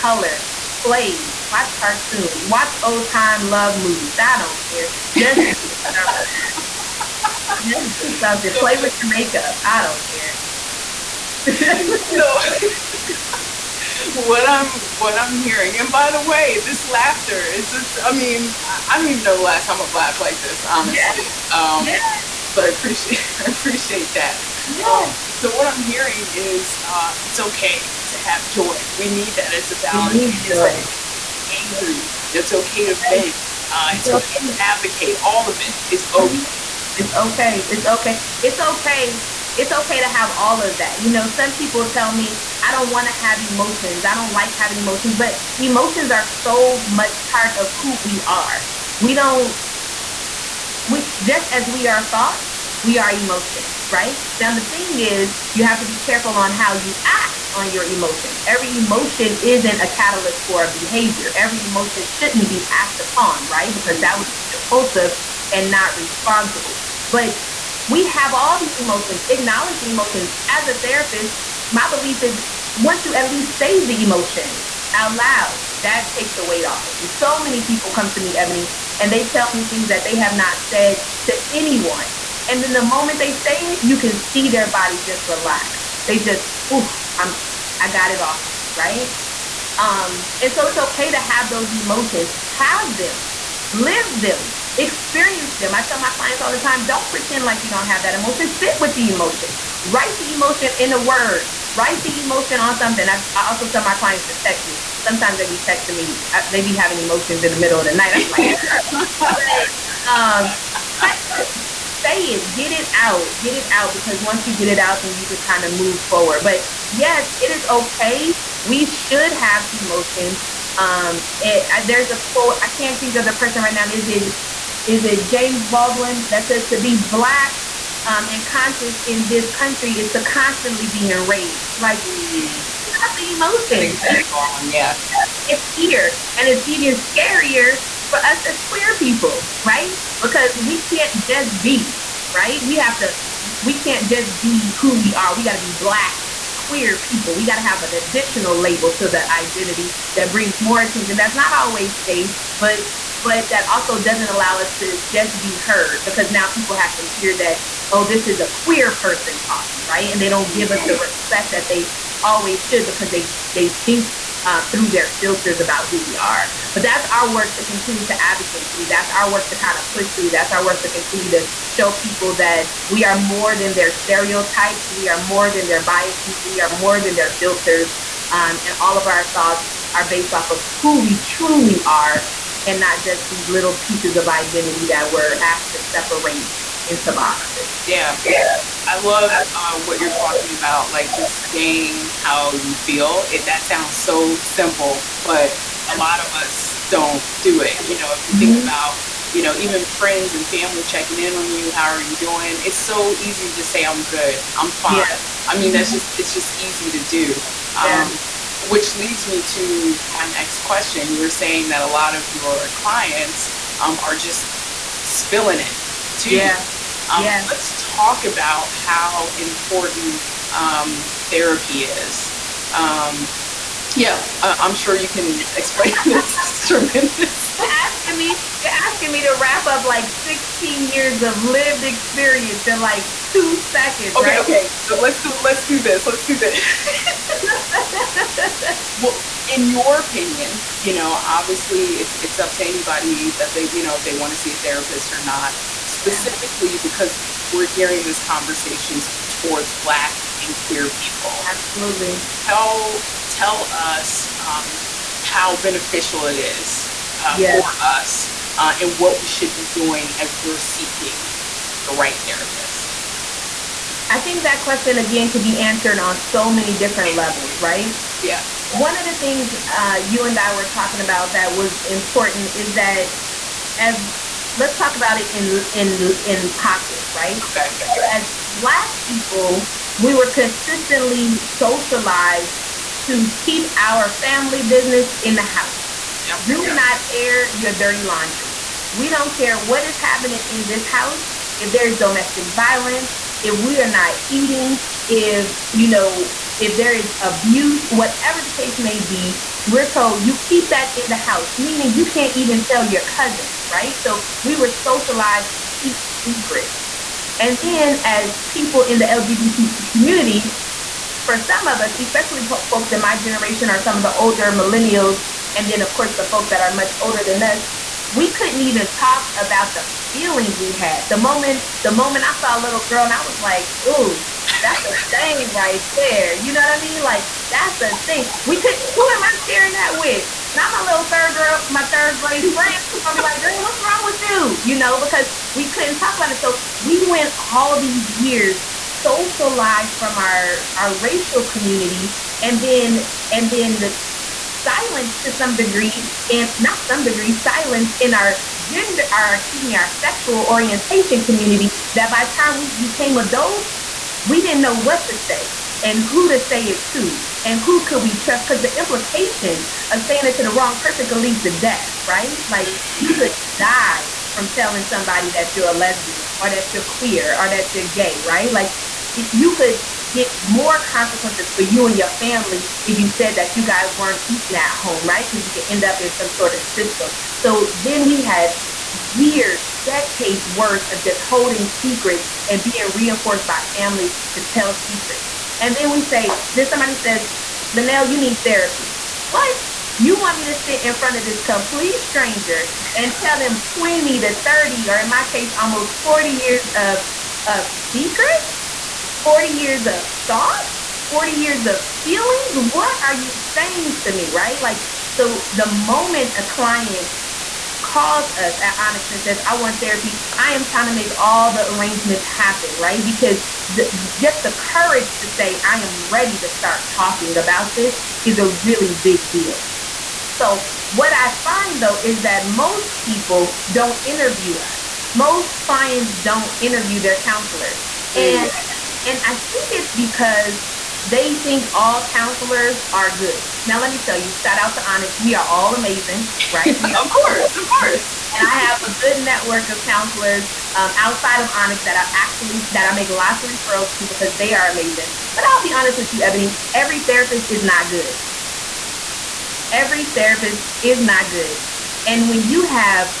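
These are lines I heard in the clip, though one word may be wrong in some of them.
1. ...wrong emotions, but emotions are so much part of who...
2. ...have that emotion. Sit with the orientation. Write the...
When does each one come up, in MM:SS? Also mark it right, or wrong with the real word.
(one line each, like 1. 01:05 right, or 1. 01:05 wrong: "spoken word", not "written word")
1. 00:44 wrong: "having", not "wrong"
2. 01:37 wrong: "emotion", not "orientation".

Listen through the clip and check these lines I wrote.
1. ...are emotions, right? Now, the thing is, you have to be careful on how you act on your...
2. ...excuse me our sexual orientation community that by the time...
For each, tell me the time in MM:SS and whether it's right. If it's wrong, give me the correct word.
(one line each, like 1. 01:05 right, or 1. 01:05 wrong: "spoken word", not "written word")
1. 00:52 right
2. 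05:49 right.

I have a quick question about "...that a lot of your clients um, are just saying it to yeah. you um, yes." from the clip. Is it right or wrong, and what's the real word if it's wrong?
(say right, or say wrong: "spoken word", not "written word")
wrong: "spilling", not "saying".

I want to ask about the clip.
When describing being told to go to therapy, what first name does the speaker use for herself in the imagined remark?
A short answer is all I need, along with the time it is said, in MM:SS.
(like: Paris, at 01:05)
LaNail, at 06:27.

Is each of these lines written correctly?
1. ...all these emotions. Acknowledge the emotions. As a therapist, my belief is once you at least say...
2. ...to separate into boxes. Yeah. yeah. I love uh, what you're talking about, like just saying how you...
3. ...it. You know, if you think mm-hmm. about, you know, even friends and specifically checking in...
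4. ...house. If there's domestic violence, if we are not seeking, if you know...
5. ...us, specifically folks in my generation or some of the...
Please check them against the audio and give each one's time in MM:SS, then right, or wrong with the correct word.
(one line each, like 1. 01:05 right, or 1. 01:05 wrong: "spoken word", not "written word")
1. 01:08 right
2. 03:05 right
3. 03:17 wrong: "family", not "specifically"
4. 04:50 wrong: "eating", not "seeking"
5. 05:11 wrong: "especially", not "specifically".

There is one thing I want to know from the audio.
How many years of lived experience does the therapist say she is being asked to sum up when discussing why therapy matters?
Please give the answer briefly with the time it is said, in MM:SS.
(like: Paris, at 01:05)
16, at 03:50.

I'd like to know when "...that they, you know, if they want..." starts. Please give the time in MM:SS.
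04:03.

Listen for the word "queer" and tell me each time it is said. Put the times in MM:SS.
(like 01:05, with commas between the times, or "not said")
02:18, 02:26, 02:38, 04:10, 06:06.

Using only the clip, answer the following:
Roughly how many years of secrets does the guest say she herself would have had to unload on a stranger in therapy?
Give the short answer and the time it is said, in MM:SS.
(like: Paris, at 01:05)
40, at 06:35.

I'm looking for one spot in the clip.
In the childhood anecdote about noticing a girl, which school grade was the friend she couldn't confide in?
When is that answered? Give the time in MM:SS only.
05:31.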